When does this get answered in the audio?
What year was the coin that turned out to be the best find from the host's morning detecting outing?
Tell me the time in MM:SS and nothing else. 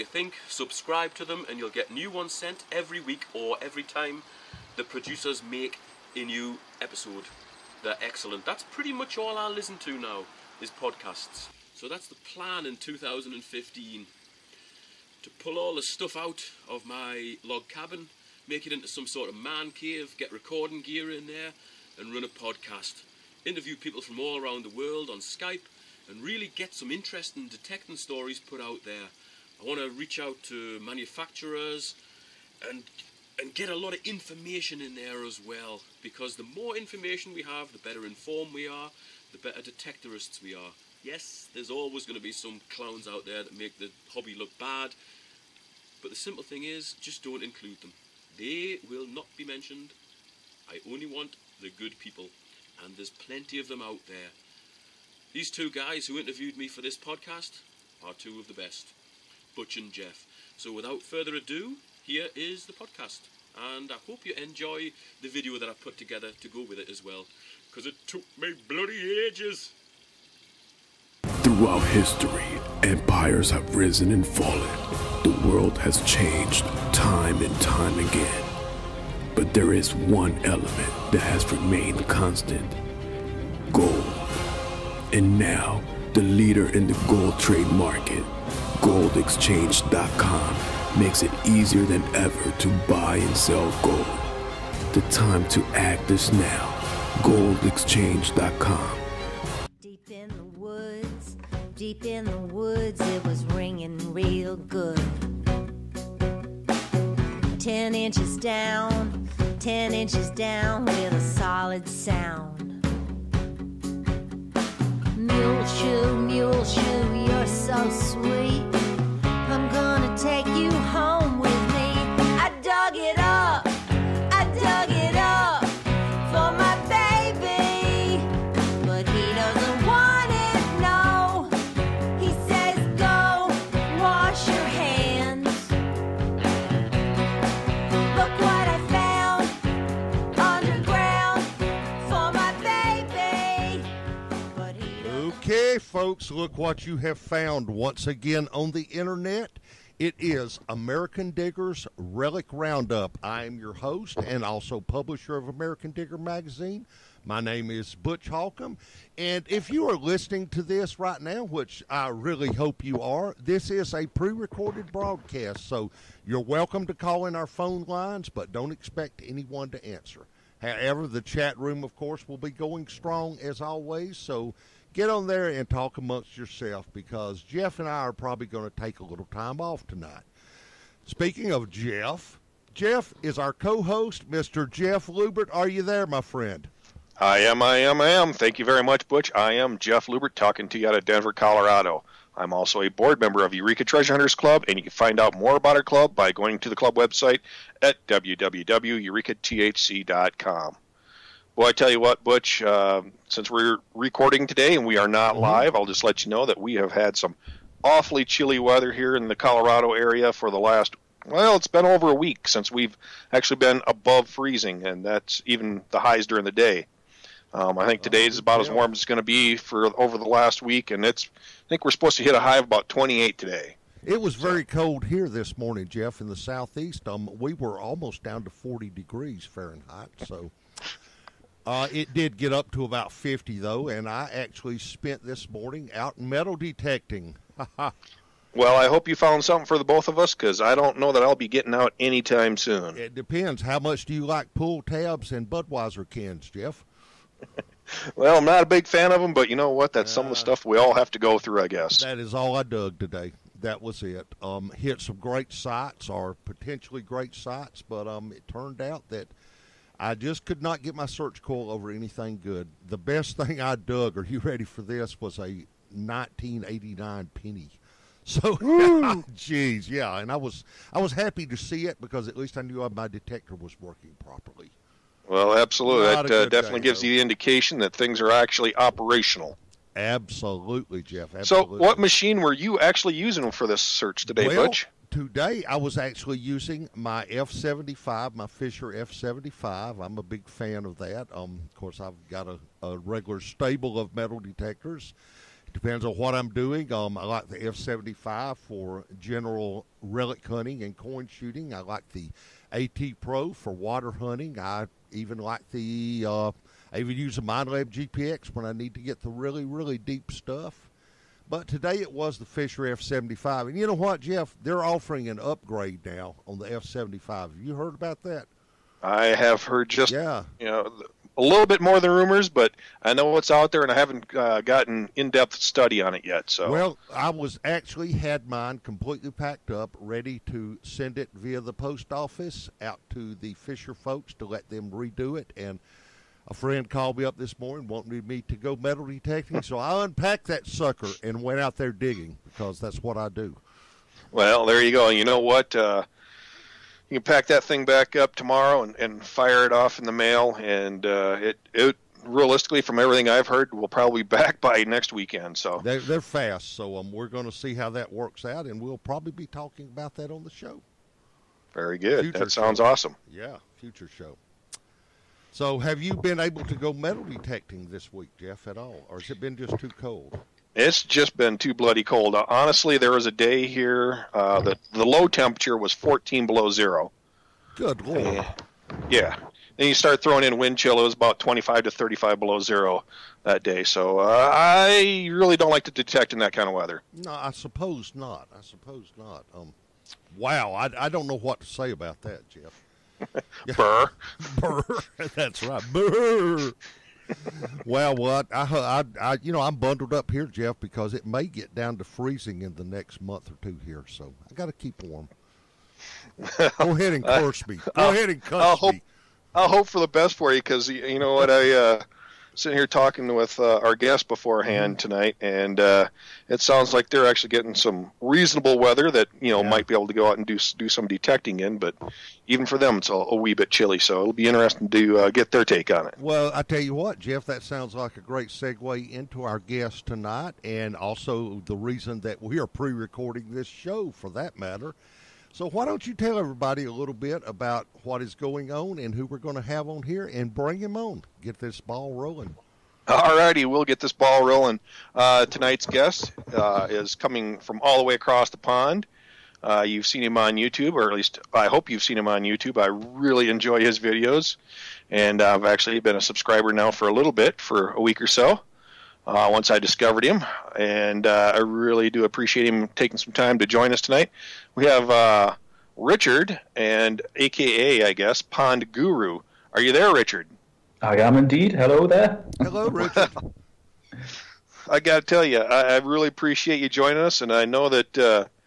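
04:25.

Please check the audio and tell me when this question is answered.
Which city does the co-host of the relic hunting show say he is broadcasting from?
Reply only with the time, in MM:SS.
03:11.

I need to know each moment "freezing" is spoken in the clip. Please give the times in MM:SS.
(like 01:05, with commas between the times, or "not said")
03:34, 06:42.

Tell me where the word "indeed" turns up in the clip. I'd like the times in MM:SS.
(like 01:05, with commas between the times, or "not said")
07:51.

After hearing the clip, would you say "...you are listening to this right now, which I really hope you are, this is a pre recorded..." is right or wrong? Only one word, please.
right.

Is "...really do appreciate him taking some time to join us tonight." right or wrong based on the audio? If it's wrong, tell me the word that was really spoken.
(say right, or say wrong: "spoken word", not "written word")
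right.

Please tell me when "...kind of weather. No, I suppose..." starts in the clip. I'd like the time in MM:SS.
06:26.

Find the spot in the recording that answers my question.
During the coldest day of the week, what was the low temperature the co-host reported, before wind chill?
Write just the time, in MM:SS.
06:15.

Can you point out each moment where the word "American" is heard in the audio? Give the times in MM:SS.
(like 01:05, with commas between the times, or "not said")
02:30, 02:35.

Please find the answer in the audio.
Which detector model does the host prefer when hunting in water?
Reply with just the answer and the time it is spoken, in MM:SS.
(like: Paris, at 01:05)
AT Pro, at 05:02.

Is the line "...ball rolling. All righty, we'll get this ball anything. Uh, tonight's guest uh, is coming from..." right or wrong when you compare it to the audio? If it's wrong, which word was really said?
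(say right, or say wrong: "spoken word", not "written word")
wrong: "rolling", not "anything".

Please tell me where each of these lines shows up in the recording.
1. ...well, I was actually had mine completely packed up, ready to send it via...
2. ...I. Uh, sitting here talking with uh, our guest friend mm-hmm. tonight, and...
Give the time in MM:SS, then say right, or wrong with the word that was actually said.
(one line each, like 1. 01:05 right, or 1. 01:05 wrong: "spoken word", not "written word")
1. 05:26 right
2. 06:51 wrong: "beforehand", not "friend".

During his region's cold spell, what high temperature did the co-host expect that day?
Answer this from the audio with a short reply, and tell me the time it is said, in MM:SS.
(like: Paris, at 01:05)
28, at 03:42.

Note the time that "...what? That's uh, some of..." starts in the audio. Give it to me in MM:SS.
04:09.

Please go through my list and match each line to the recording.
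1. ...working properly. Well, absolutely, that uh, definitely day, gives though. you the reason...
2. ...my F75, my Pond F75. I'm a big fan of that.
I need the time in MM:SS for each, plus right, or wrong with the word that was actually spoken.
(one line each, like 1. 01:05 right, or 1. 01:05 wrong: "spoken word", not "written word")
1. 04:33 wrong: "indication", not "reason"
2. 04:46 wrong: "Fisher", not "Pond".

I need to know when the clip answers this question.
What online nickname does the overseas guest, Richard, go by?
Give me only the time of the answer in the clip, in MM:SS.
07:48.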